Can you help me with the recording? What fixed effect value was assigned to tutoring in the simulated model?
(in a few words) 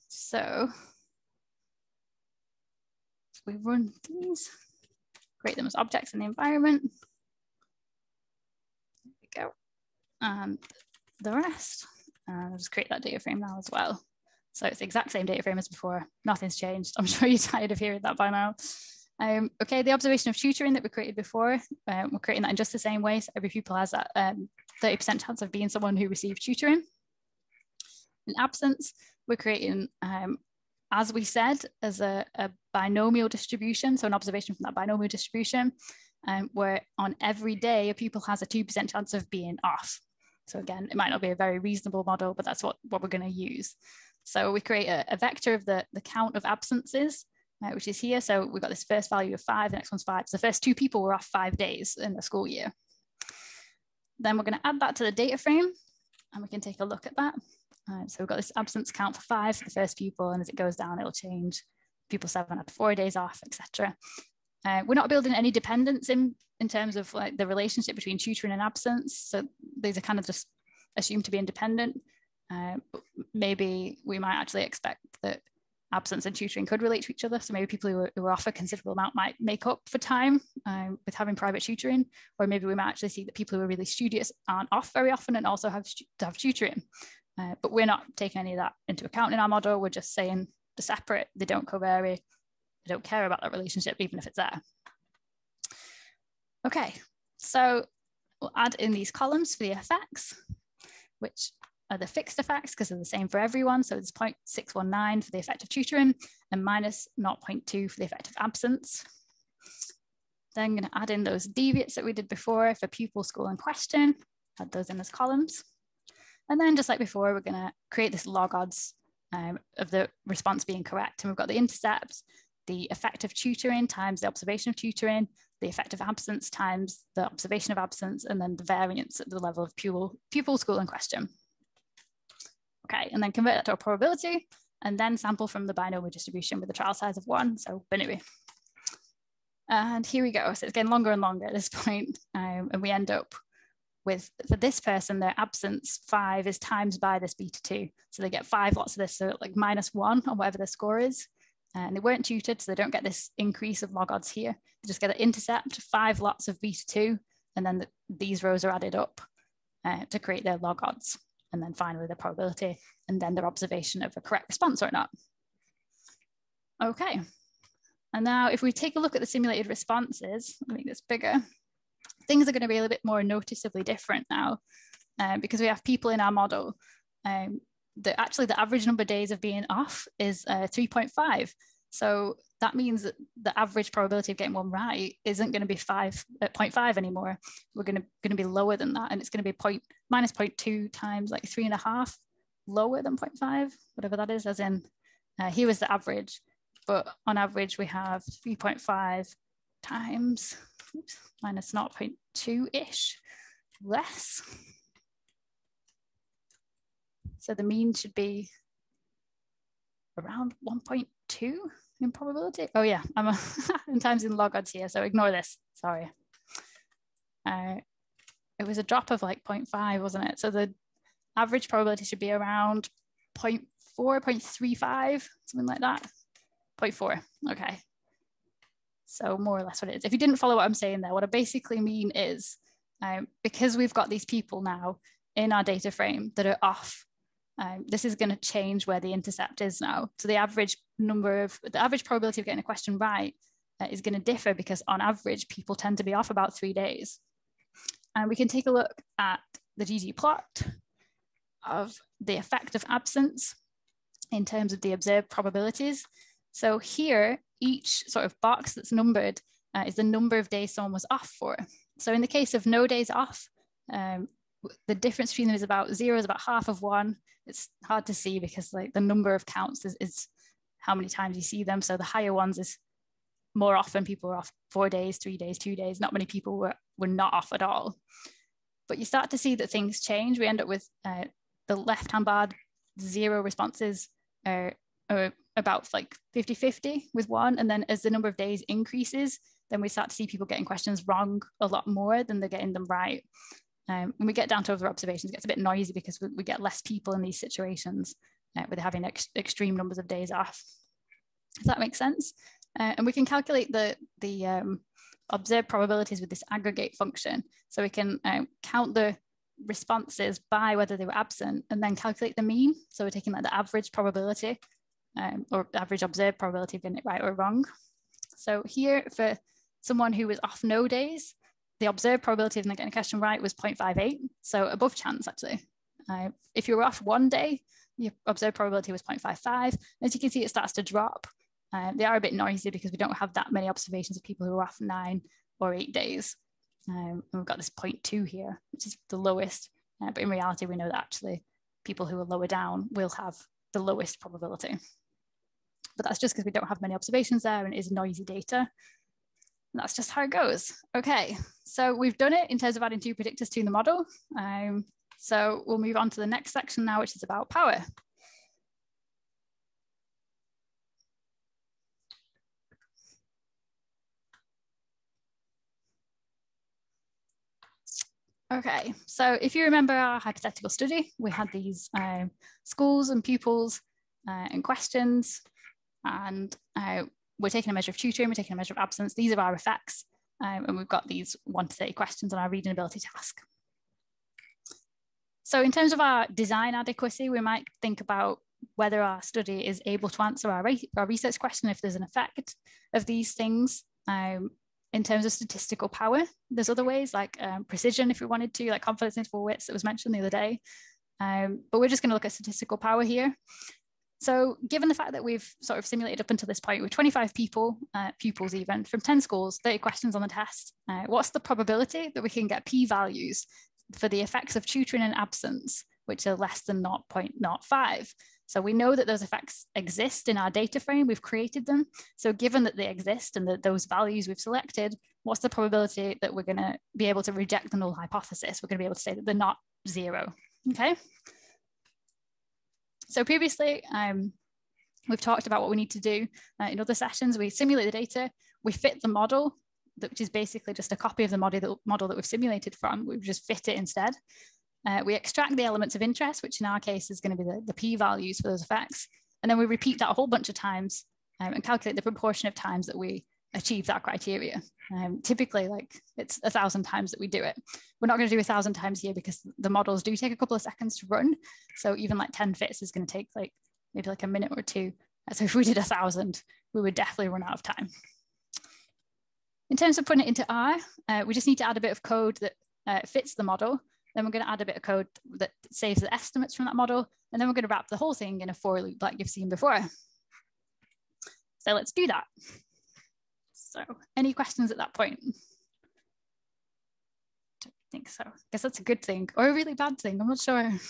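0.619.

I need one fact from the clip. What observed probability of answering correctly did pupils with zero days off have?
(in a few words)
0.58.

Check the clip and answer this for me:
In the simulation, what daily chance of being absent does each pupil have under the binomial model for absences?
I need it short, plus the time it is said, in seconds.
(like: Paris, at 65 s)
2%, at 38 s.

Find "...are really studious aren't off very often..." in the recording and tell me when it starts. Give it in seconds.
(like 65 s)
83 s.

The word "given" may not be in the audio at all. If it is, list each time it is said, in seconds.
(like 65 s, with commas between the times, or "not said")
404 s, 422 s.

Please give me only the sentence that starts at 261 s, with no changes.
So in the case of no days off, um, the difference between them is about zero is about half of one.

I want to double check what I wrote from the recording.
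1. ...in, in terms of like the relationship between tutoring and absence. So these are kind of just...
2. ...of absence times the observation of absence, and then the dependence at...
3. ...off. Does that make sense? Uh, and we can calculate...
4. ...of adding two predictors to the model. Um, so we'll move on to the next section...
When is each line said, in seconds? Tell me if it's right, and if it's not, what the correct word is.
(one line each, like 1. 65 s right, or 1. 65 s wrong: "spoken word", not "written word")
1. 66 s right
2. 125 s wrong: "variance", not "dependence"
3. 300 s right
4. 352 s right.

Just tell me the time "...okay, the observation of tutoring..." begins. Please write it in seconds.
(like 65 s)
19 s.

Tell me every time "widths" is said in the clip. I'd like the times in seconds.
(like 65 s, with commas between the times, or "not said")
399 s.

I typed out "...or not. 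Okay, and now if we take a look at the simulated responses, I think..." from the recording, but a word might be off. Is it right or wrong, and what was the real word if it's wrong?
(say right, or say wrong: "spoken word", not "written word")
right.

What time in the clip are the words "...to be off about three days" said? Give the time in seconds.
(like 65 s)
245 s.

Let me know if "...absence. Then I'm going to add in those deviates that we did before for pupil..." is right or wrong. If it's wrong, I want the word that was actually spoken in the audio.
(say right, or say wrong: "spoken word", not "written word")
right.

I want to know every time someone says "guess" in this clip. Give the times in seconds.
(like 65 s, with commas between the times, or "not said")
488 s.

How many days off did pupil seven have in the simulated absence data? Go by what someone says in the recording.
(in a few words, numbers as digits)
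4.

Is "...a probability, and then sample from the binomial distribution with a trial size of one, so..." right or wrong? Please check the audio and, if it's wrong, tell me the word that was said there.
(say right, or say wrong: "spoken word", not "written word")
right.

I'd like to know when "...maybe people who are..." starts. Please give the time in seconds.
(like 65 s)
77 s.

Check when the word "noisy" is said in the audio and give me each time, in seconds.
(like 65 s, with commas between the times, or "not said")
295 s, 332 s, 347 s.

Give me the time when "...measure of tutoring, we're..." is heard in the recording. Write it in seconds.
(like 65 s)
377 s.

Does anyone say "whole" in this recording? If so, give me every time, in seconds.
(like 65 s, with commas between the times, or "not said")
450 s, 477 s.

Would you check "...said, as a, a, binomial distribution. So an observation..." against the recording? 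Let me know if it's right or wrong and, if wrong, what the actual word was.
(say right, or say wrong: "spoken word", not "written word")
right.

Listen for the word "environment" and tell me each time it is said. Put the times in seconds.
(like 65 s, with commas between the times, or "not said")
6 s.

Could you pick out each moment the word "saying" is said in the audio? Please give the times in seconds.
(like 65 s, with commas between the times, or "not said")
90 s, 230 s.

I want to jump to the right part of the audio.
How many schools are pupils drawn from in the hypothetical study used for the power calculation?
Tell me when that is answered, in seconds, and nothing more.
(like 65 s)
408 s.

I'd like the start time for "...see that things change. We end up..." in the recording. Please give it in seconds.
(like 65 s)
279 s.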